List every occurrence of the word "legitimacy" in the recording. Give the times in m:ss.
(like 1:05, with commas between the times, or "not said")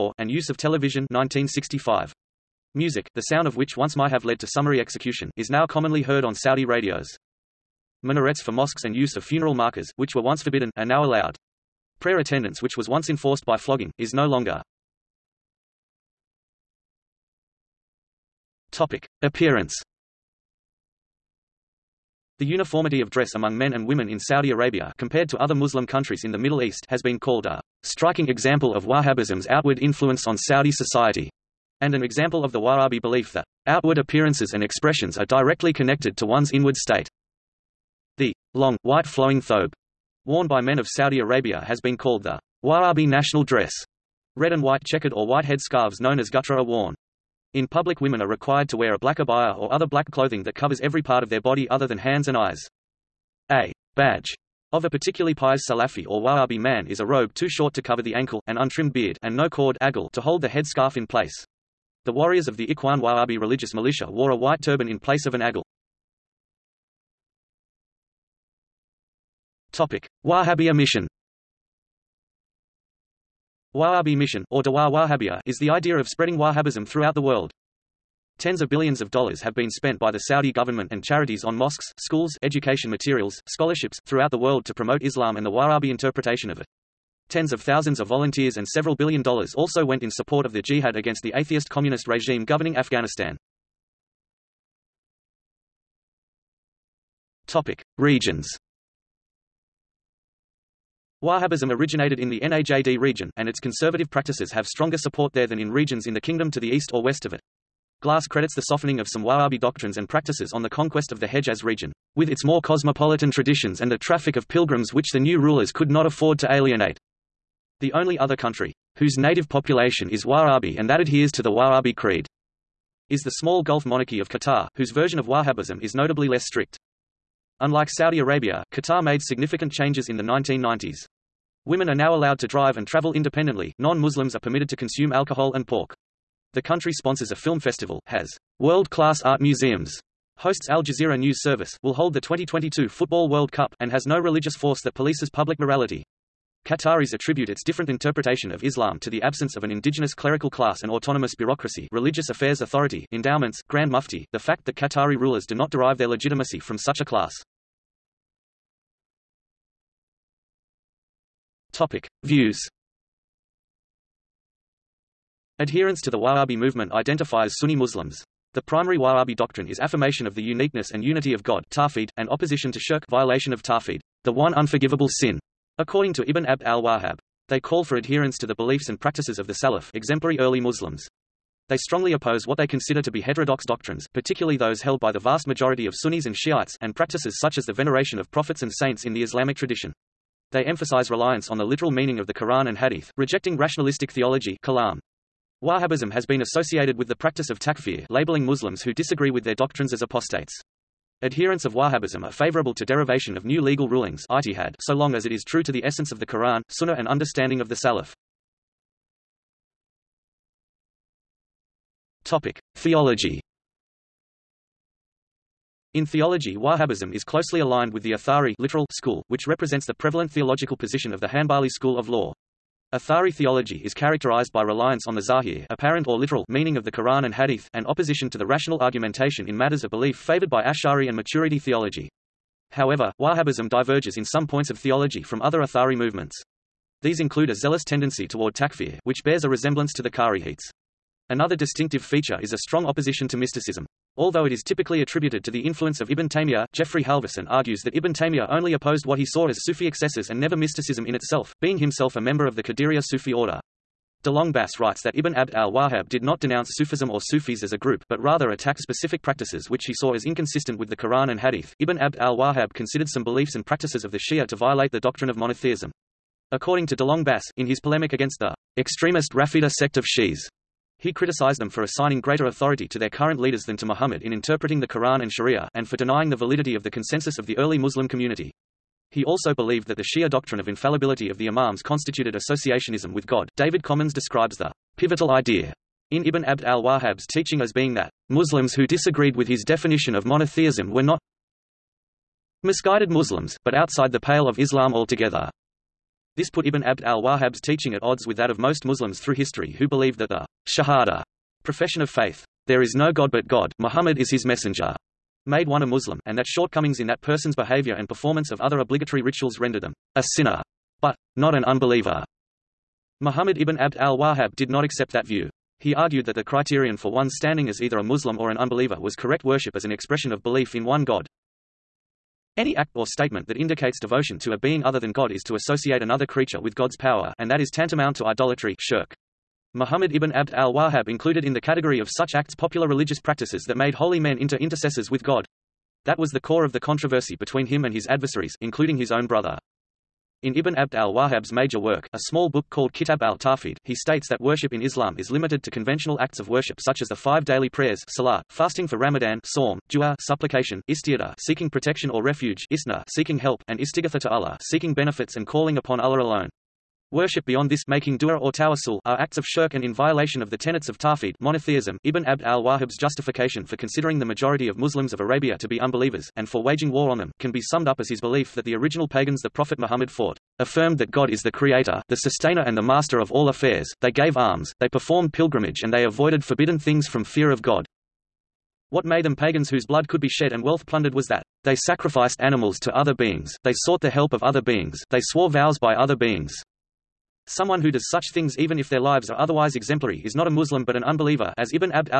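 2:36.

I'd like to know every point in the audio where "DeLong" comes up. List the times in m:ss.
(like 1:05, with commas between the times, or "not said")
4:14, 4:26.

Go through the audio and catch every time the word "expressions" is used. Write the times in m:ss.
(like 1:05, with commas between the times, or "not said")
0:34, 5:19.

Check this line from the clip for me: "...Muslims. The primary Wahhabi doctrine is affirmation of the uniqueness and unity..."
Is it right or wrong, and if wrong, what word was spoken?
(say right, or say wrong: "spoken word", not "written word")
right.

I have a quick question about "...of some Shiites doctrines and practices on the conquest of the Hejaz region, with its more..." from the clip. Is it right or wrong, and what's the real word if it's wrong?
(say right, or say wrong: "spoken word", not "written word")
wrong: "Wahhabi", not "Shiites".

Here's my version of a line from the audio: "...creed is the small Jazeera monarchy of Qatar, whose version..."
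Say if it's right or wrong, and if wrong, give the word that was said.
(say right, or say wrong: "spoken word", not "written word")
wrong: "Gulf", not "Jazeera".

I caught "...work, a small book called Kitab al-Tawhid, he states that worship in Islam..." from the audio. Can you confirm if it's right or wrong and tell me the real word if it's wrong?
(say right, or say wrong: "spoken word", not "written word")
right.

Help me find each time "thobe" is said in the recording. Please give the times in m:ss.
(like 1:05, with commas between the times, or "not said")
0:39.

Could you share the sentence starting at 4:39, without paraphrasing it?
He also believed that the Shia doctrine of infallibility of the Imams constituted associationism with God.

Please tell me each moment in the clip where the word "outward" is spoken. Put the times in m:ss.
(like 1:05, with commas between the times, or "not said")
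0:29, 0:33.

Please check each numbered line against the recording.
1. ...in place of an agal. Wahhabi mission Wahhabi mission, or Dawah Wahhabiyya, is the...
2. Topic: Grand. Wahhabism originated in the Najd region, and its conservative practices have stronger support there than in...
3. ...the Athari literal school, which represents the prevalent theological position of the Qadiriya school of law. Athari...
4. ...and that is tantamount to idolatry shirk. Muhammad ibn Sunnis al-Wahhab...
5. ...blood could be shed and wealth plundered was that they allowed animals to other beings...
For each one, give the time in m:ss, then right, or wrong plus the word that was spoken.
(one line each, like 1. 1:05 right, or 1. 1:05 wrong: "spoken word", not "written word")
1. 1:04 right
2. 1:37 wrong: "Regions", not "Grand"
3. 3:38 wrong: "Hanbali", not "Qadiriya"
4. 5:27 wrong: "Abd", not "Sunnis"
5. 6:19 wrong: "sacrificed", not "allowed".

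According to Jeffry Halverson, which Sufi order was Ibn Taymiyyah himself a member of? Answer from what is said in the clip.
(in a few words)
Qadiriya.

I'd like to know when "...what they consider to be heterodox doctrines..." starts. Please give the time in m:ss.
3:02.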